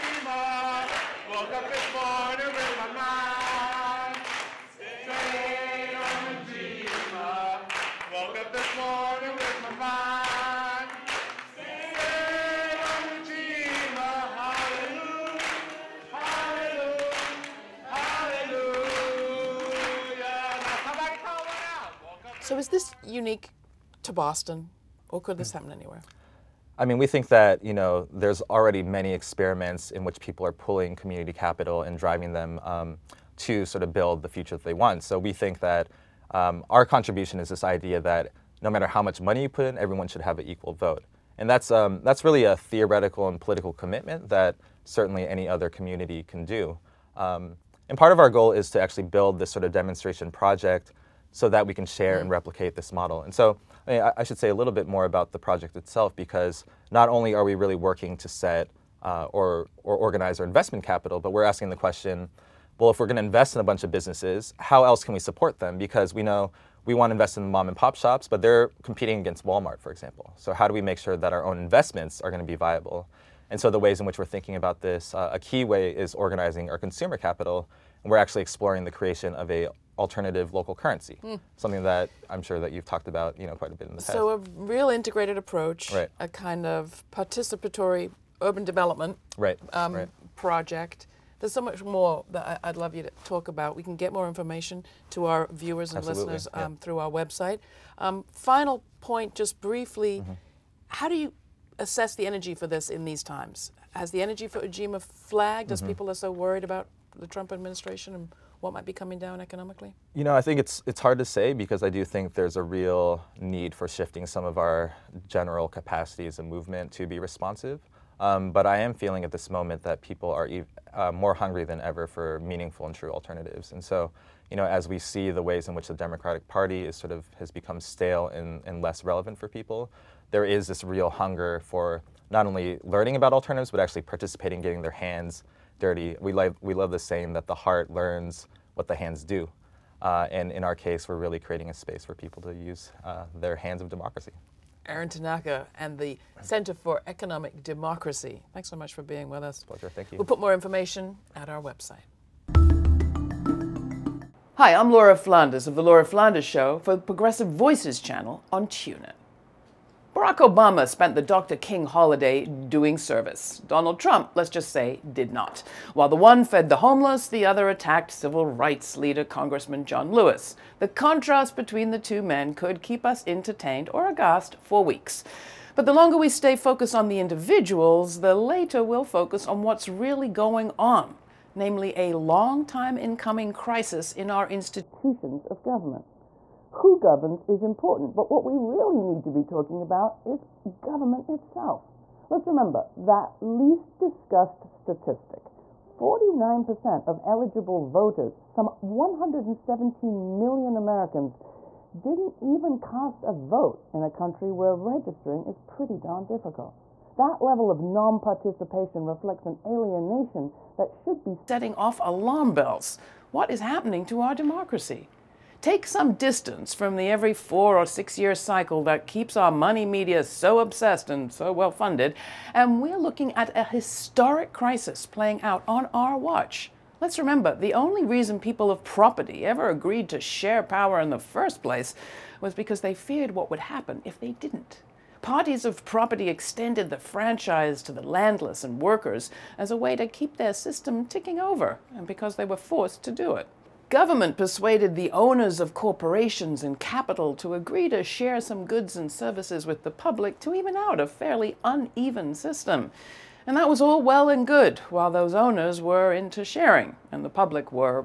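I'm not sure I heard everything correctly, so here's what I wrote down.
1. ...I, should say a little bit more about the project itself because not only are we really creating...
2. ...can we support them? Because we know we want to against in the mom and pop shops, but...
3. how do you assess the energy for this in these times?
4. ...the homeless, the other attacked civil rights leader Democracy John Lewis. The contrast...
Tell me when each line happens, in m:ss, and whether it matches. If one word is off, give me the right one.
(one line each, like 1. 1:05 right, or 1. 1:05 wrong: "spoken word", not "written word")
1. 0:54 wrong: "working", not "creating"
2. 1:05 wrong: "invest", not "against"
3. 1:40 right
4. 2:46 wrong: "Congressman", not "Democracy".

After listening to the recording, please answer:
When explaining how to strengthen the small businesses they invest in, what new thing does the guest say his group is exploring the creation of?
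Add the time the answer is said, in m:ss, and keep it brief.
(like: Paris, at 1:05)
alternative local currency, at 1:19.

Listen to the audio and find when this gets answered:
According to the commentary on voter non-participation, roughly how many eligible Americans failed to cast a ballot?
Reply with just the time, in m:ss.
3:18.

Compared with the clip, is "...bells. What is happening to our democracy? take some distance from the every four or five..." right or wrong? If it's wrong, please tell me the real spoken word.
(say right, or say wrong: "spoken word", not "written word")
wrong: "six", not "five".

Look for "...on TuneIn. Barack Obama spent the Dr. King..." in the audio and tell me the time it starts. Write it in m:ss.
2:38.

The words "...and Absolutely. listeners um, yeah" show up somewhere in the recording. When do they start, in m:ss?
1:35.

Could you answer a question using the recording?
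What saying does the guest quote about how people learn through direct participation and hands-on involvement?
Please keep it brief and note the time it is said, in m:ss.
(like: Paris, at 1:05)
The heart learns what the hands do, at 2:17.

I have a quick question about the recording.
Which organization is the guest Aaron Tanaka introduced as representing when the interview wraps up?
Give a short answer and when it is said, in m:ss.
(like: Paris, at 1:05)
Center for Economic Democracy, at 2:26.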